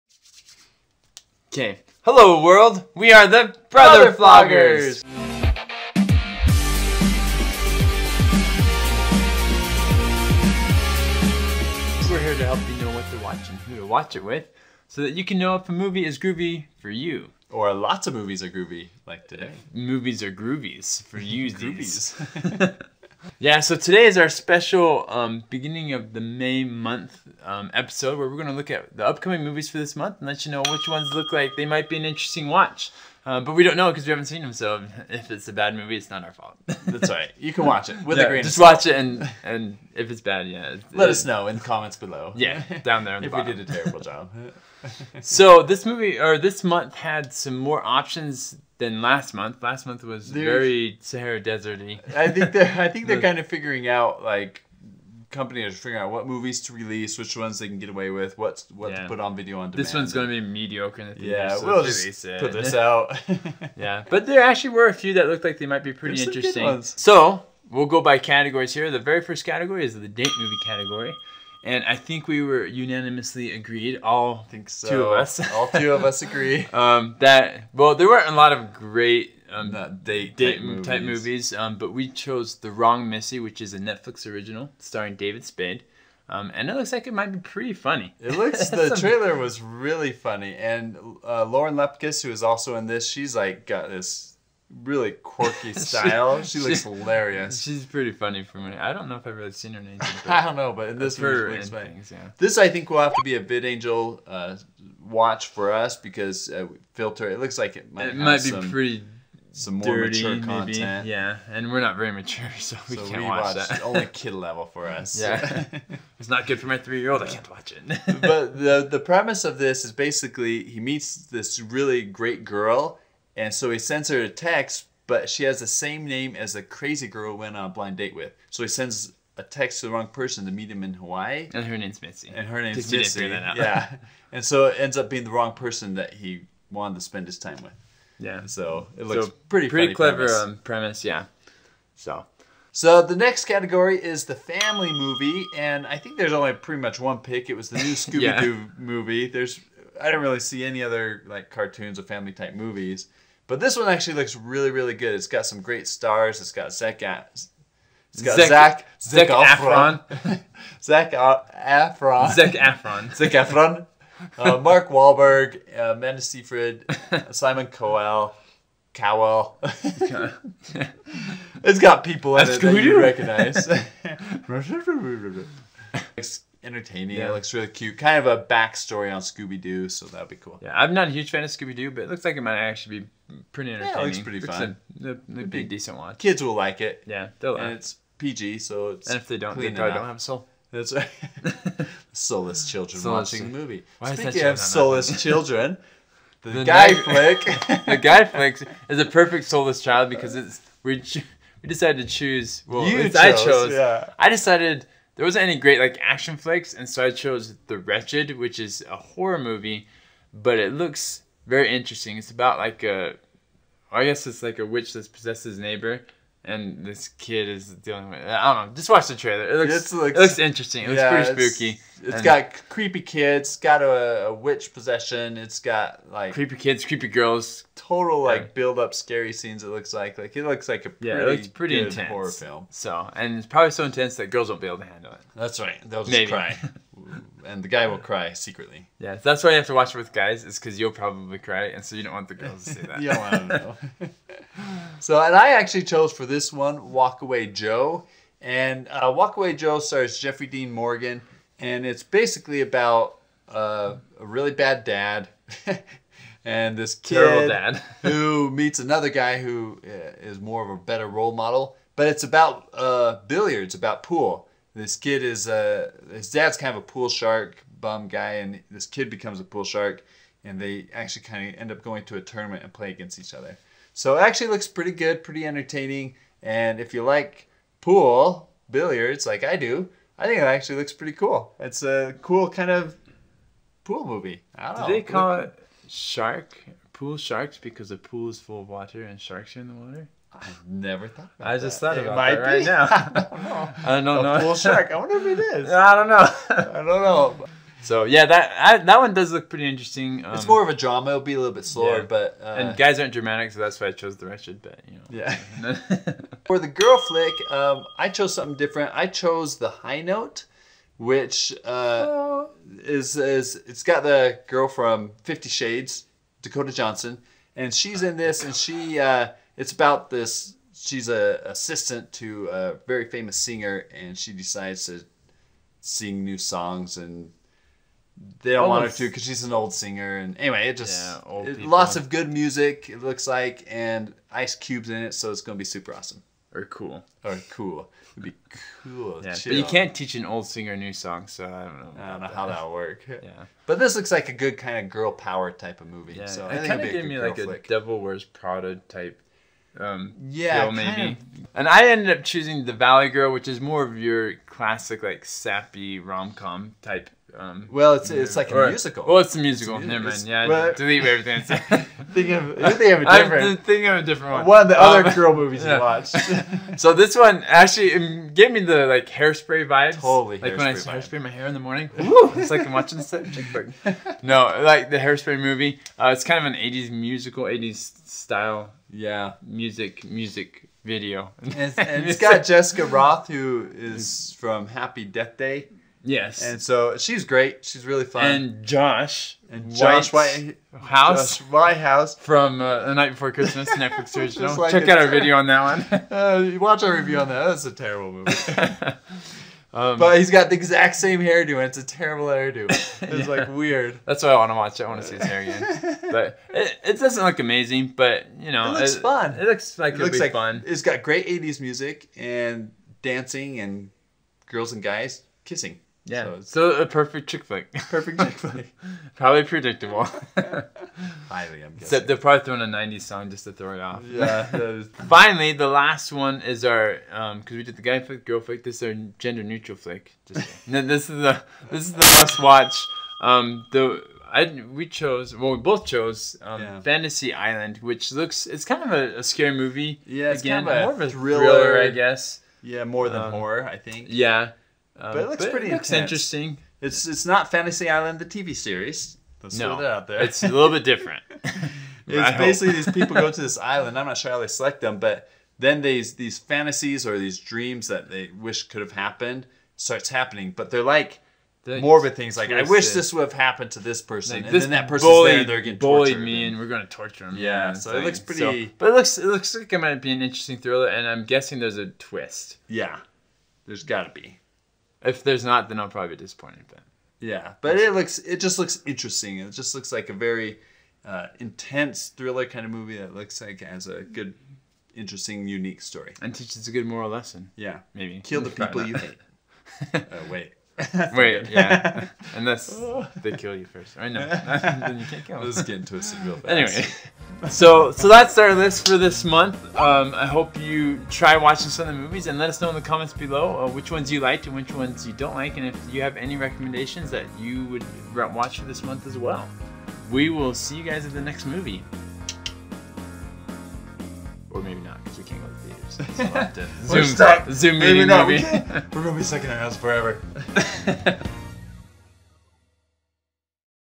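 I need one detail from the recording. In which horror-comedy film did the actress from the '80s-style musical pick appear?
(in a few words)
Happy Death Day.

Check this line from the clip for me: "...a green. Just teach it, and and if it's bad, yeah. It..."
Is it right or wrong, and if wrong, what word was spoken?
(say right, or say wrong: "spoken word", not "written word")
wrong: "watch", not "teach".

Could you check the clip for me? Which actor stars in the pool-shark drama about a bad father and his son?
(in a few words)
Jeffrey Dean Morgan.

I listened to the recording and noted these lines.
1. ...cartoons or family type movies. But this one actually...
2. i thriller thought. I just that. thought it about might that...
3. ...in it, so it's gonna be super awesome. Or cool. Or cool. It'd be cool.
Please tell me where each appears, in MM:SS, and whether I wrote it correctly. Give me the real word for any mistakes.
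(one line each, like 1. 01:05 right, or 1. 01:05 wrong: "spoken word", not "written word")
1. 02:31 right
2. 04:50 wrong: "never", not "thriller"
3. 05:34 right.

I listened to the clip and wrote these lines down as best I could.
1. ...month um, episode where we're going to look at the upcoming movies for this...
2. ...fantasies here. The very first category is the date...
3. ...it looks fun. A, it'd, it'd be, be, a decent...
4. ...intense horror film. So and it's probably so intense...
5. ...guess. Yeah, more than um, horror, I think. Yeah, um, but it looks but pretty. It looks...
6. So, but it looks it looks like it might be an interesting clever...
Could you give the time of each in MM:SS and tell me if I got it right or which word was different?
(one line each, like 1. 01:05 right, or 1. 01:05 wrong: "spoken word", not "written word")
1. 00:26 right
2. 01:08 wrong: "categories", not "fantasies"
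3. 03:04 right
4. 03:51 right
5. 07:21 right
6. 07:48 wrong: "thriller", not "clever".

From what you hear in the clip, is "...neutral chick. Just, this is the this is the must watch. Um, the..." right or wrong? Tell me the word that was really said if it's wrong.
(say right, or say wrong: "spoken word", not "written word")
wrong: "flick", not "chick".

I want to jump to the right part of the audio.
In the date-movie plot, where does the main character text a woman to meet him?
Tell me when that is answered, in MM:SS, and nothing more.
02:10.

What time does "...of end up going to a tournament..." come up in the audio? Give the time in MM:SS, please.
04:31.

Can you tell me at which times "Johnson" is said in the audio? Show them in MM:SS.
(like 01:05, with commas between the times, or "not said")
05:16.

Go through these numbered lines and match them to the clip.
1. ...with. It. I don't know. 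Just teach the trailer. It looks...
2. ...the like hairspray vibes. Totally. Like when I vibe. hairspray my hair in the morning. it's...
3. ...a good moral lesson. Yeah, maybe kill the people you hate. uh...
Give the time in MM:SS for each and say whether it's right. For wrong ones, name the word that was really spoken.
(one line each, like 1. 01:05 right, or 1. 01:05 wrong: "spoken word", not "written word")
1. 03:38 wrong: "watch", not "teach"
2. 06:08 right
3. 08:06 right.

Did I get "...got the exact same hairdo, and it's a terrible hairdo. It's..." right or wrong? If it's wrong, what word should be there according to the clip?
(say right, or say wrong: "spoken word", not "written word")
right.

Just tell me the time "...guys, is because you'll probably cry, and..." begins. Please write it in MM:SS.
04:00.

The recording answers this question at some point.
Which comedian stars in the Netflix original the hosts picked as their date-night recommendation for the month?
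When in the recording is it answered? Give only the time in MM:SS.
01:25.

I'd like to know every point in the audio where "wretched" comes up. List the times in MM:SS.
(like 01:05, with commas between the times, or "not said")
03:27, 05:04.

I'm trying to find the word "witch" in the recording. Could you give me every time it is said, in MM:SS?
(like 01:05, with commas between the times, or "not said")
03:34, 03:44.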